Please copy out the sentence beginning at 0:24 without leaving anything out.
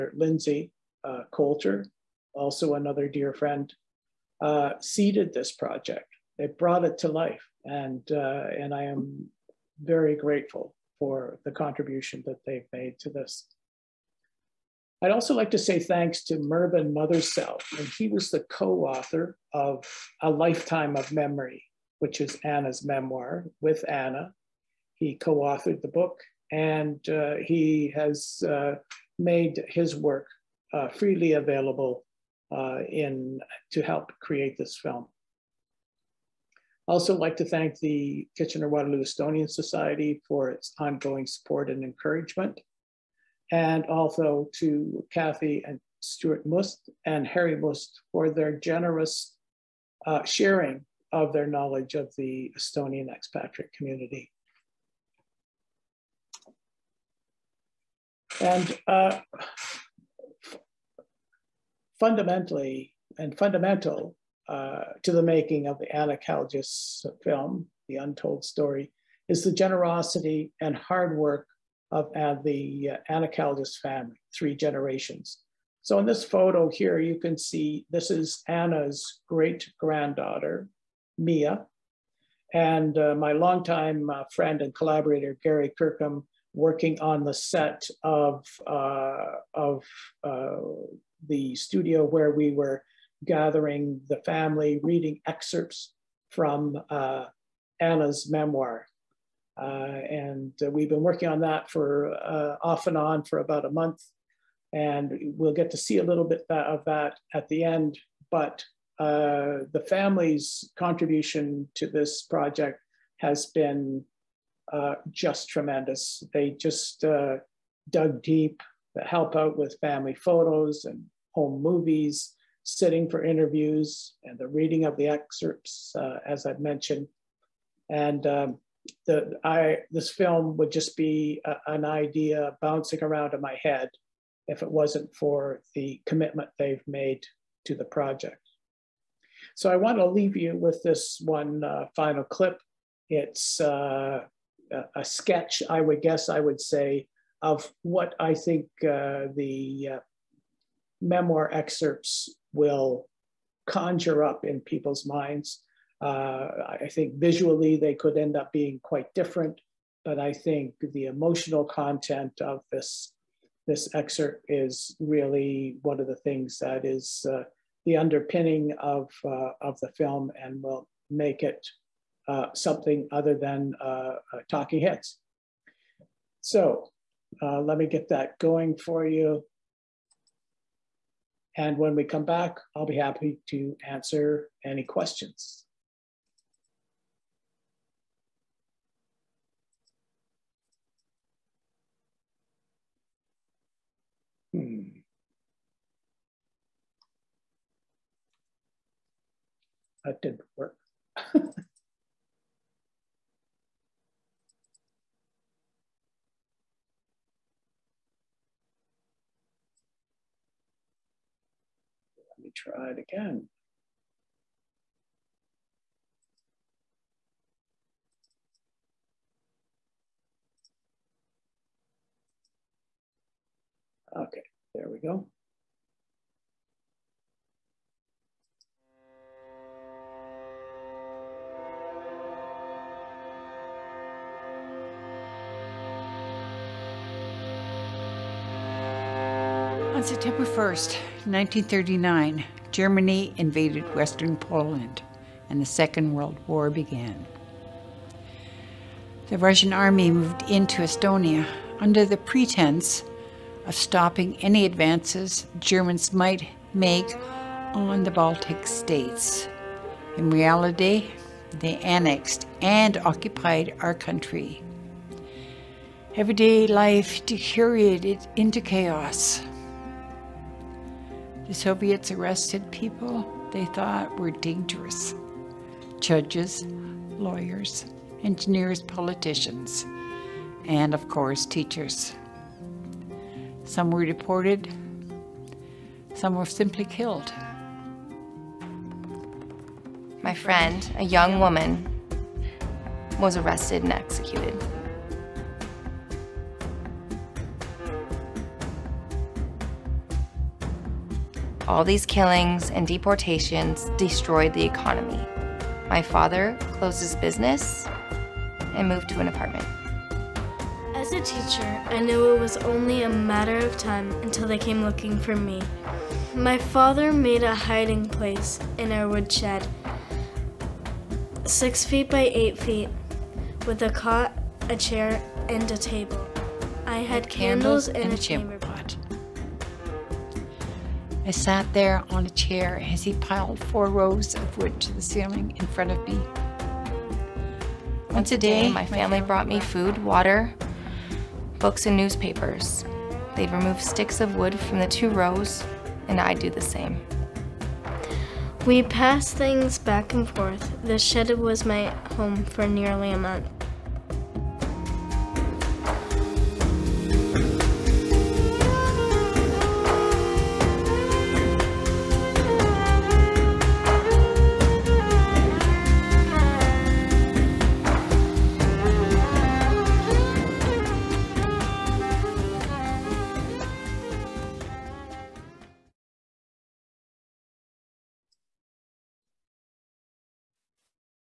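He co-authored the book and uh, he has uh, made his work uh, freely available uh, in to help create this film.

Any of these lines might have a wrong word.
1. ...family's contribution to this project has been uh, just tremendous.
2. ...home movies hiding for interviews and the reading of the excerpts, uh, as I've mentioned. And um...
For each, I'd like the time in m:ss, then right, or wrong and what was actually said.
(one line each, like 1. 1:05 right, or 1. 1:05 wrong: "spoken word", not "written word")
1. 1:49 right
2. 2:01 wrong: "sitting", not "hiding".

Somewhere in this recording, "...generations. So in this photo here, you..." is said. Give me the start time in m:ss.
1:14.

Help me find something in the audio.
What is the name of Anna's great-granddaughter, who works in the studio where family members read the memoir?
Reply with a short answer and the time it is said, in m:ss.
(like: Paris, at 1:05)
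Mia, at 1:21.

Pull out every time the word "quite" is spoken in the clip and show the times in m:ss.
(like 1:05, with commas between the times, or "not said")
2:38.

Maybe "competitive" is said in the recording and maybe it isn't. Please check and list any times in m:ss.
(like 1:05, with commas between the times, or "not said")
not said.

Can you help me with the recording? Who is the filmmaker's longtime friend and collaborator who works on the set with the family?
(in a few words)
Gary Kirkham.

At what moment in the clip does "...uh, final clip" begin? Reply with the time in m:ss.
2:21.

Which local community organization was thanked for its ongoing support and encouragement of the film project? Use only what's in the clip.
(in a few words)
Kitchener-Waterloo Estonian Society.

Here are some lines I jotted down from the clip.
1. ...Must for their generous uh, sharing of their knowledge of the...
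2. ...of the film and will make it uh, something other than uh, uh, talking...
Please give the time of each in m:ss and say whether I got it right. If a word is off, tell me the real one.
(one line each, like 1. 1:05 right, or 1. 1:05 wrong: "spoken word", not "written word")
1. 0:47 right
2. 2:49 right.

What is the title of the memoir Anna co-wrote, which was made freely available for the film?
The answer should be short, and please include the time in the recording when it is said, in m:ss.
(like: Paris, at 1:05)
A Lifetime of Memory, at 0:20.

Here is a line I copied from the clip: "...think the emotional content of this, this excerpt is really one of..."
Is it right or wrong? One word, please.
right.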